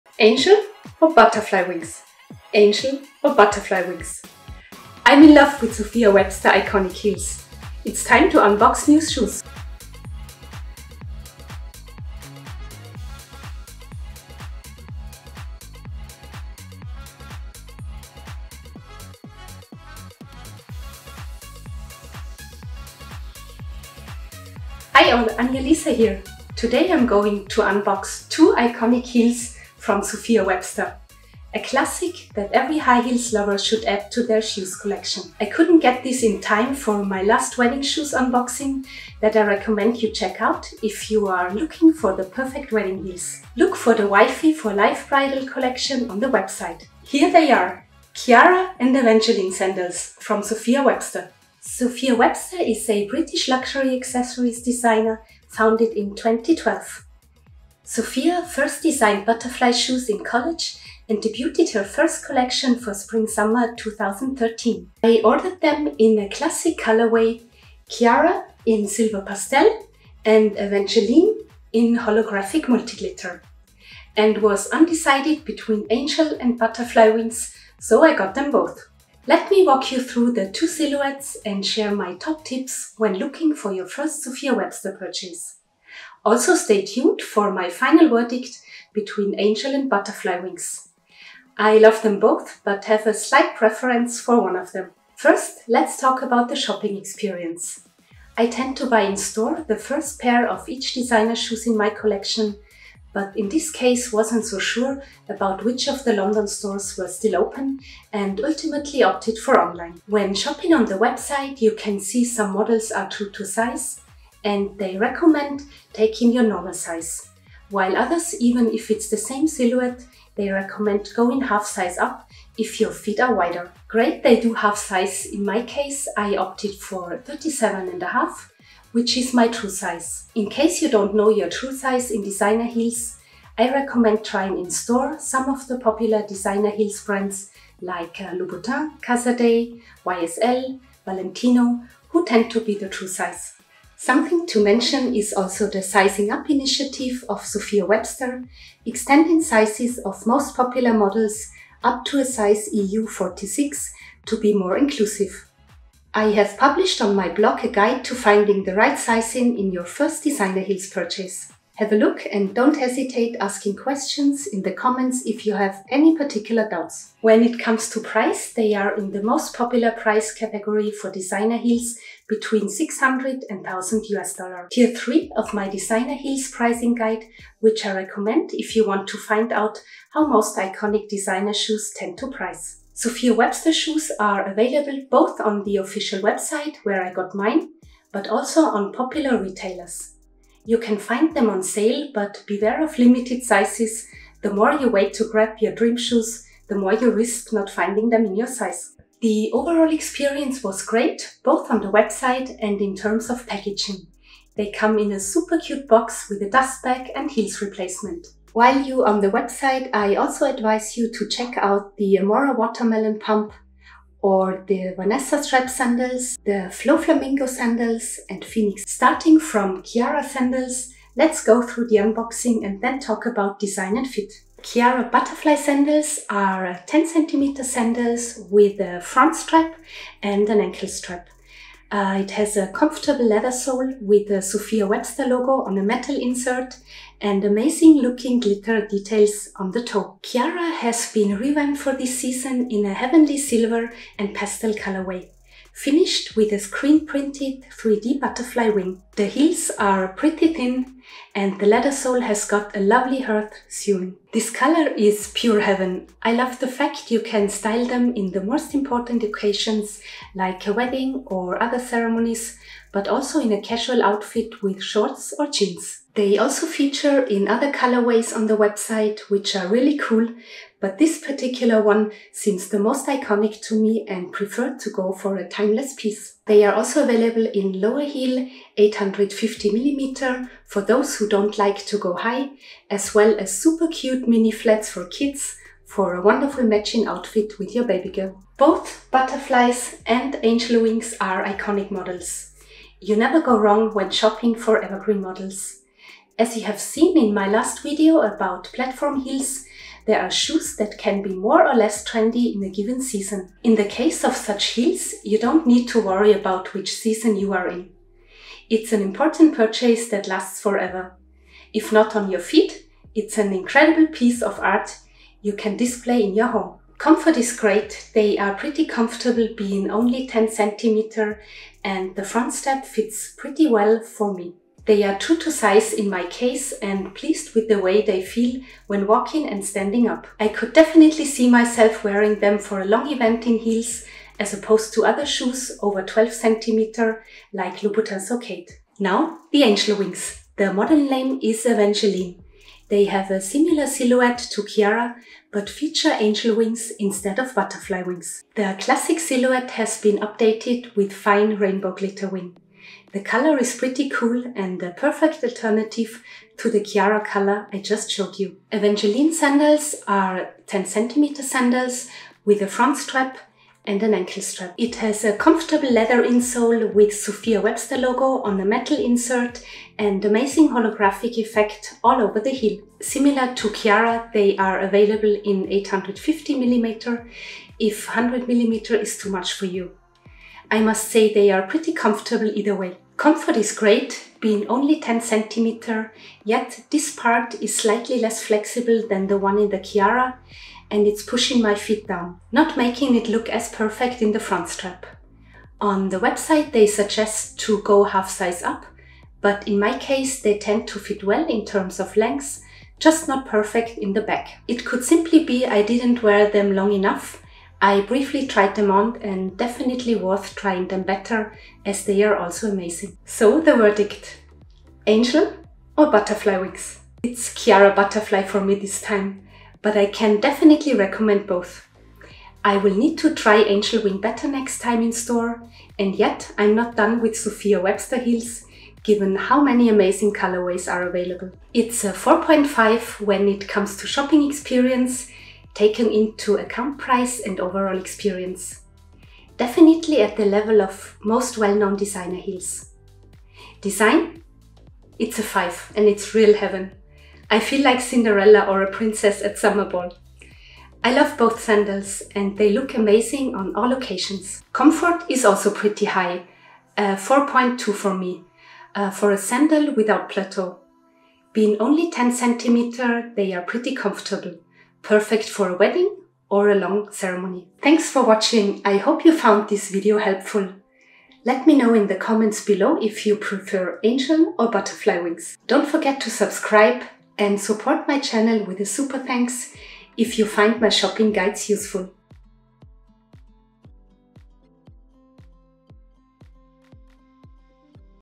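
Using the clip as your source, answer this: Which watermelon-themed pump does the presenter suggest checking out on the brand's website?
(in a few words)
Amora.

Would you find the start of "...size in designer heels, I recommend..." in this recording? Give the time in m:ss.
2:11.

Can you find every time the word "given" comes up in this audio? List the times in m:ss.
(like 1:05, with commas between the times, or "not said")
5:02, 7:09.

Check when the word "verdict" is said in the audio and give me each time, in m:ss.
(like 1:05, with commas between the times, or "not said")
1:28, 6:53.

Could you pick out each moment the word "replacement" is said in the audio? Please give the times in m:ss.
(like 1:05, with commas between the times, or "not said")
3:27.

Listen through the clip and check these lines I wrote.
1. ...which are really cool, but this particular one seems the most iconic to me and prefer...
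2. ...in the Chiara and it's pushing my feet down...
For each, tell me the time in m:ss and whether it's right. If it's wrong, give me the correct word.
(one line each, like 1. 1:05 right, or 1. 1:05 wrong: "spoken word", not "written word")
1. 4:29 right
2. 6:29 right.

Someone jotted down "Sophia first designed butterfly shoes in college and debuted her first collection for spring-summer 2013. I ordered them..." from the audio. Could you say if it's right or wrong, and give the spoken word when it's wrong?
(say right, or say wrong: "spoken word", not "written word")
right.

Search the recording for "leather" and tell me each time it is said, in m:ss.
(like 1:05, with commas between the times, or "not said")
3:53, 4:11, 6:05.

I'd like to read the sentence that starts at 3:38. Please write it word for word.
Starting from Chiara sandals, let's go through the unboxing and then talk about design and fit.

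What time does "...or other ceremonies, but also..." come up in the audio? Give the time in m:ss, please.
4:21.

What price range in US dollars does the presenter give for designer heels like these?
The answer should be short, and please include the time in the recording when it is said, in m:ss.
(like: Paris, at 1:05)
600 to 1000 US dollars, at 2:52.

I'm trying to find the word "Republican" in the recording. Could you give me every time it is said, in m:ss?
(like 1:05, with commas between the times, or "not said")
not said.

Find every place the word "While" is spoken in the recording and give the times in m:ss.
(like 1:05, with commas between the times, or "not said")
1:57, 3:28.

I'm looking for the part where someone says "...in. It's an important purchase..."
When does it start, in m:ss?
5:07.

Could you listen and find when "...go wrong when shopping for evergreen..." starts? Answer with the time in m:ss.
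4:53.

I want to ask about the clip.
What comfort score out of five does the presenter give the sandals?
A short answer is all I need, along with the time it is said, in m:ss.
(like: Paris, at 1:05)
4.2, at 7:37.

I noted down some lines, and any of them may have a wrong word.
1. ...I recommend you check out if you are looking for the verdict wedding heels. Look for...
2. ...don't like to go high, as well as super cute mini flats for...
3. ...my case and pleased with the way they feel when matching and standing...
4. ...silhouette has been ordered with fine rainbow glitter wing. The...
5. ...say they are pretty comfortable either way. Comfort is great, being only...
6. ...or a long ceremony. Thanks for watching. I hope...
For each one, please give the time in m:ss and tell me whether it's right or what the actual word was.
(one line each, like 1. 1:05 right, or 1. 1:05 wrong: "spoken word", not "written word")
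1. 0:39 wrong: "perfect", not "verdict"
2. 4:41 right
3. 5:26 wrong: "walking", not "matching"
4. 5:49 wrong: "updated", not "ordered"
5. 6:21 right
6. 7:46 right.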